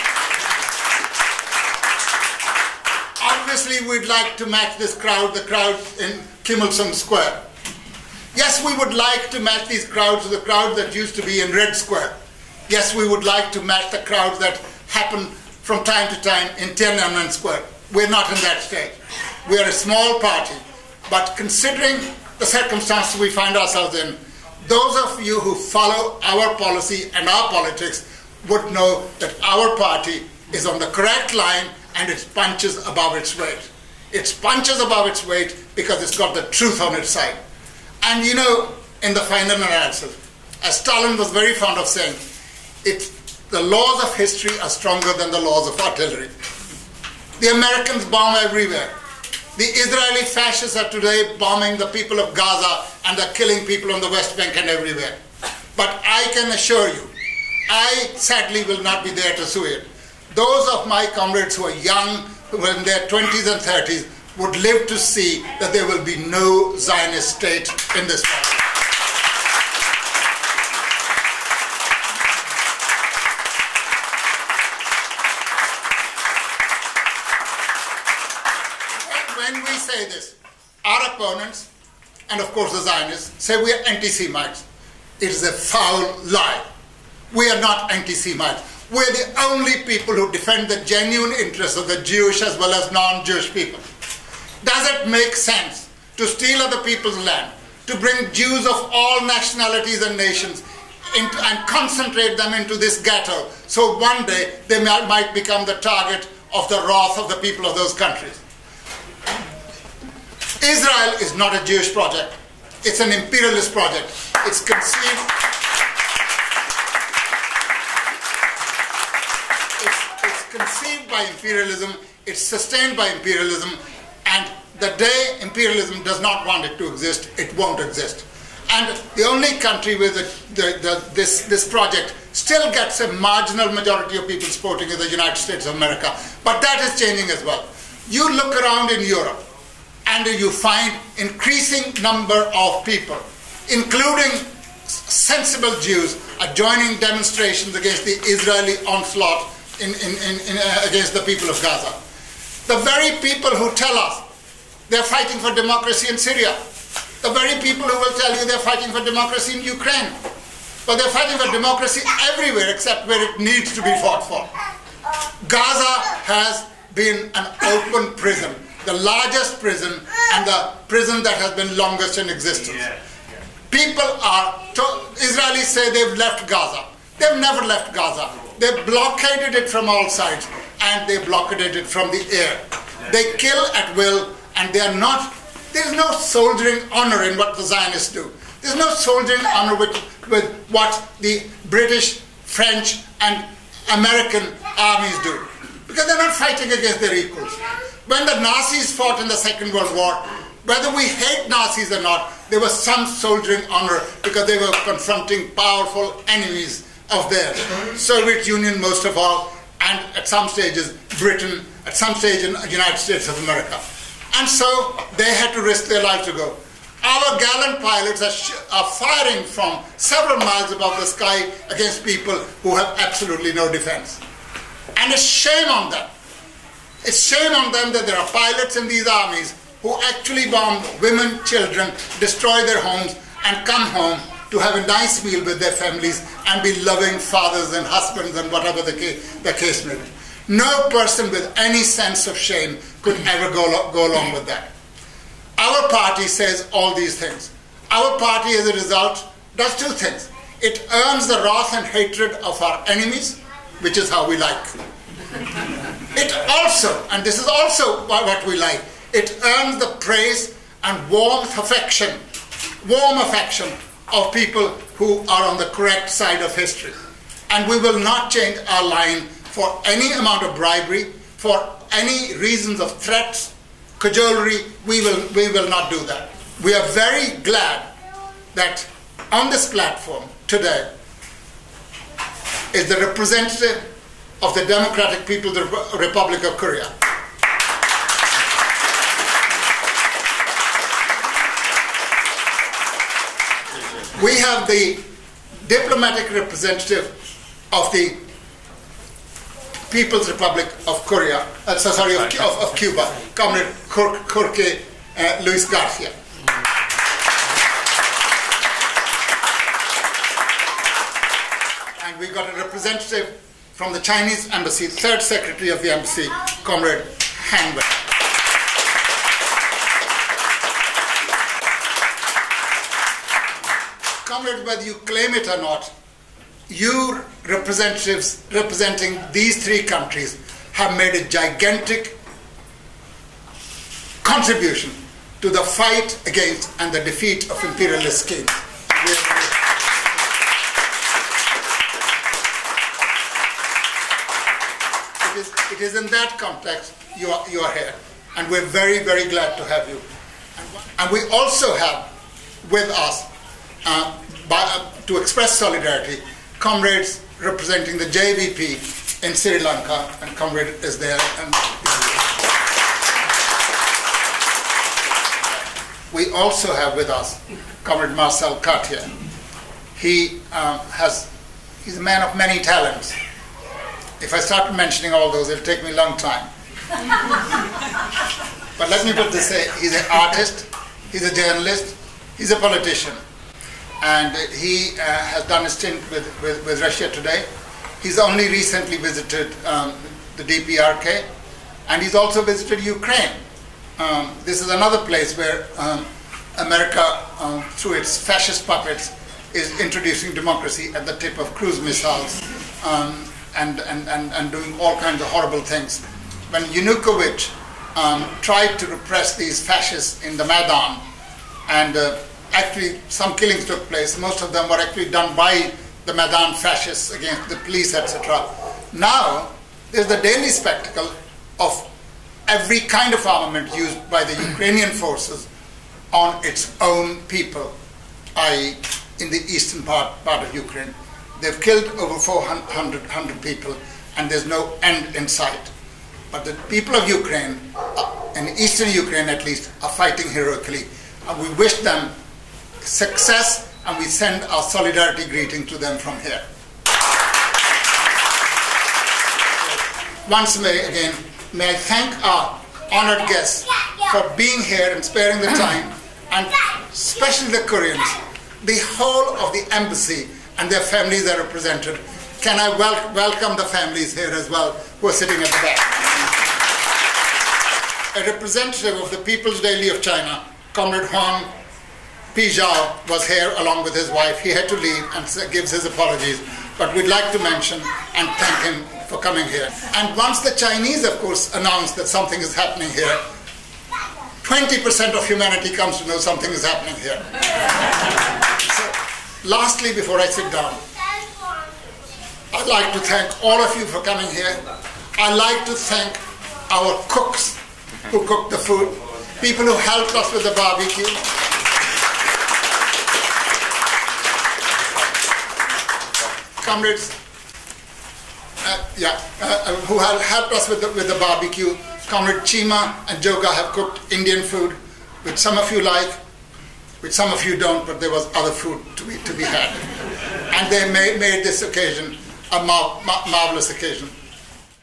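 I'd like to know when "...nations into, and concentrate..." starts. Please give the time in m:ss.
1:40.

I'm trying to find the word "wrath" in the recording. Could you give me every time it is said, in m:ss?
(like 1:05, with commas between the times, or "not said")
1:46, 4:11.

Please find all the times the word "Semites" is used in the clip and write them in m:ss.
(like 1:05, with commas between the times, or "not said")
1:23, 1:27.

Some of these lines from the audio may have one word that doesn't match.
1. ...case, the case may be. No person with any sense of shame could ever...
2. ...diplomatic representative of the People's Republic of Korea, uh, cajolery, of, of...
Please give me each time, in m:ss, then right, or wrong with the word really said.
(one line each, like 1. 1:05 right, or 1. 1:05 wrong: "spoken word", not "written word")
1. 3:58 right
2. 4:55 wrong: "sorry", not "cajolery".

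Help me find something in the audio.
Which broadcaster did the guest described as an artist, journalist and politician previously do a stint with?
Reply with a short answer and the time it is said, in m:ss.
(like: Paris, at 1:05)
Russia Today, at 6:26.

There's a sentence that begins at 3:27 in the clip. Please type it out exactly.
Soviet Union most of all, and at some stages Britain, at some stage in the United States of America.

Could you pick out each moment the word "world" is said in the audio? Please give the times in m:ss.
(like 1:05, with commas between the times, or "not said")
1:08, 3:19.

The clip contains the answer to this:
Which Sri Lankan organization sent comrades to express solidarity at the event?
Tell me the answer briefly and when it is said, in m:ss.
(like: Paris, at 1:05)
JVP, at 5:58.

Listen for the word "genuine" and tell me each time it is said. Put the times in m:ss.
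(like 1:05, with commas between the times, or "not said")
1:30.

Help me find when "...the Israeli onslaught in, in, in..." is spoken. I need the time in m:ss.
2:28.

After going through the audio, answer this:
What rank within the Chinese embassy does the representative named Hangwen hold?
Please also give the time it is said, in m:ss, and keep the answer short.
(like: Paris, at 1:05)
Third secretary, at 5:14.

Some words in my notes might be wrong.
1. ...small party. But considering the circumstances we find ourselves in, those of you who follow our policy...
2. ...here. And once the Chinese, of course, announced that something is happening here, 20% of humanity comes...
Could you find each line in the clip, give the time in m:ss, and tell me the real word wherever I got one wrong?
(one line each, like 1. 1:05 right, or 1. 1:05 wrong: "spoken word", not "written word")
1. 0:19 right
2. 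7:59 right.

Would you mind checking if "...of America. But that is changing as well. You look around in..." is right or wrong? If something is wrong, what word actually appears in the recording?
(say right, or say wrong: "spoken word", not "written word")
right.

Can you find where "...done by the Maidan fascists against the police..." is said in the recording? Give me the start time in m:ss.
6:55.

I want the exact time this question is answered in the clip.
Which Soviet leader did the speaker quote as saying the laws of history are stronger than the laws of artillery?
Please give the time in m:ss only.
0:40.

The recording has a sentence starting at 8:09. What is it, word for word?
Lastly, before I sit down, I'd like to thank all of you for coming here.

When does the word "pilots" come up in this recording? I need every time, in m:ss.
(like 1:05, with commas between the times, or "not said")
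3:37, 3:48.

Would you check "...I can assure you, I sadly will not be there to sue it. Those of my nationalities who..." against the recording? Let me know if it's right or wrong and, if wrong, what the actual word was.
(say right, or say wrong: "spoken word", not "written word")
wrong: "comrades", not "nationalities".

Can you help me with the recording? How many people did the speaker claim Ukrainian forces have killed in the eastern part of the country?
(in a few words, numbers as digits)
Over 400.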